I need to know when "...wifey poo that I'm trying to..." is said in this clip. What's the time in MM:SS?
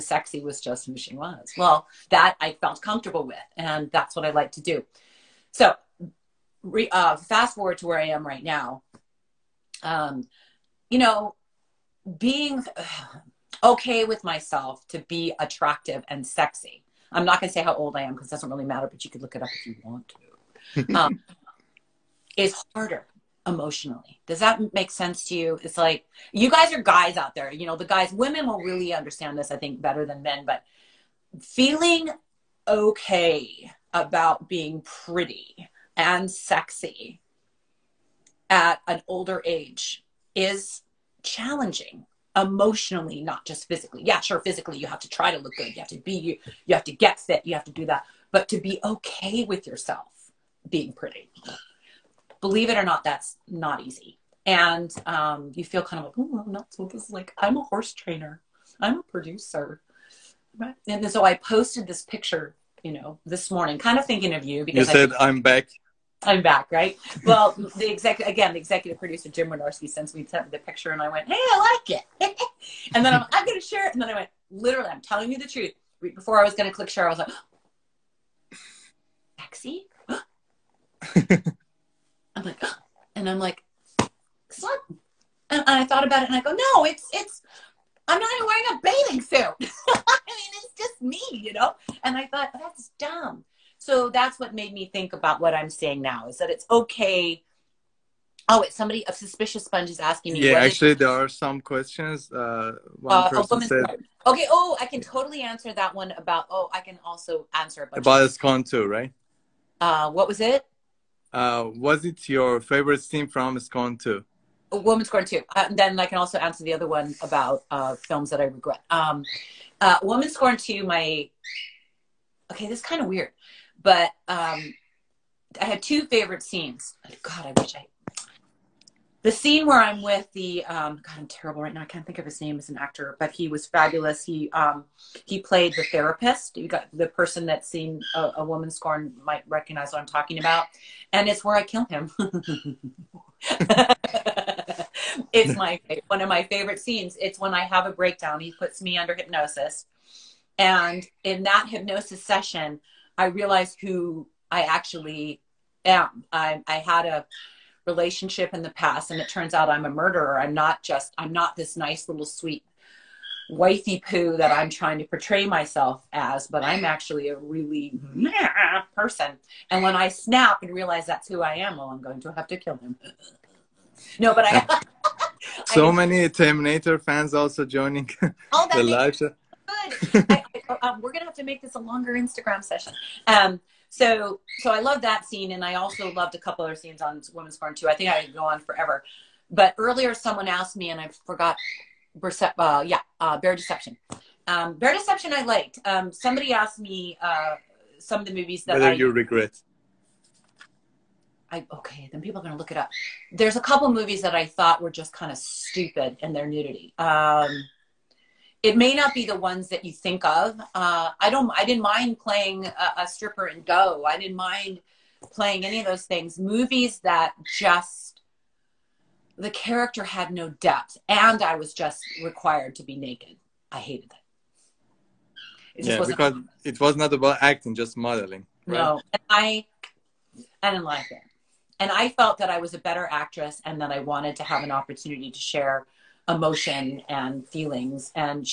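02:43.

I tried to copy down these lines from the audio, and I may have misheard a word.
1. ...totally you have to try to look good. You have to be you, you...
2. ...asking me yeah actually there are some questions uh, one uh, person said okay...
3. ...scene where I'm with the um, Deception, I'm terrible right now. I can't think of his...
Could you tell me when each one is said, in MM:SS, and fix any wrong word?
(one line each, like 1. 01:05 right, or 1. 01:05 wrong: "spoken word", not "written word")
1. 00:44 wrong: "physically", not "totally"
2. 01:39 right
3. 02:09 wrong: "God", not "Deception".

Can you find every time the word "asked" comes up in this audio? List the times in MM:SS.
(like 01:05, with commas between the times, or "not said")
03:10, 03:16.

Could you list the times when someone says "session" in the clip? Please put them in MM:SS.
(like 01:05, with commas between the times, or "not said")
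02:32, 03:02.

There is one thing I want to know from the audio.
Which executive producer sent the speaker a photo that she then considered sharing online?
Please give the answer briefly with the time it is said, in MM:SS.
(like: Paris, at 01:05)
Jim Wynorski, at 01:09.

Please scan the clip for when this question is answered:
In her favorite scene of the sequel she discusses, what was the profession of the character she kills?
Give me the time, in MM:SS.
02:15.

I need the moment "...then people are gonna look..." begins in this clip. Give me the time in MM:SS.
03:22.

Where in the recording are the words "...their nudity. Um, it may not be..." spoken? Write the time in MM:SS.
03:26.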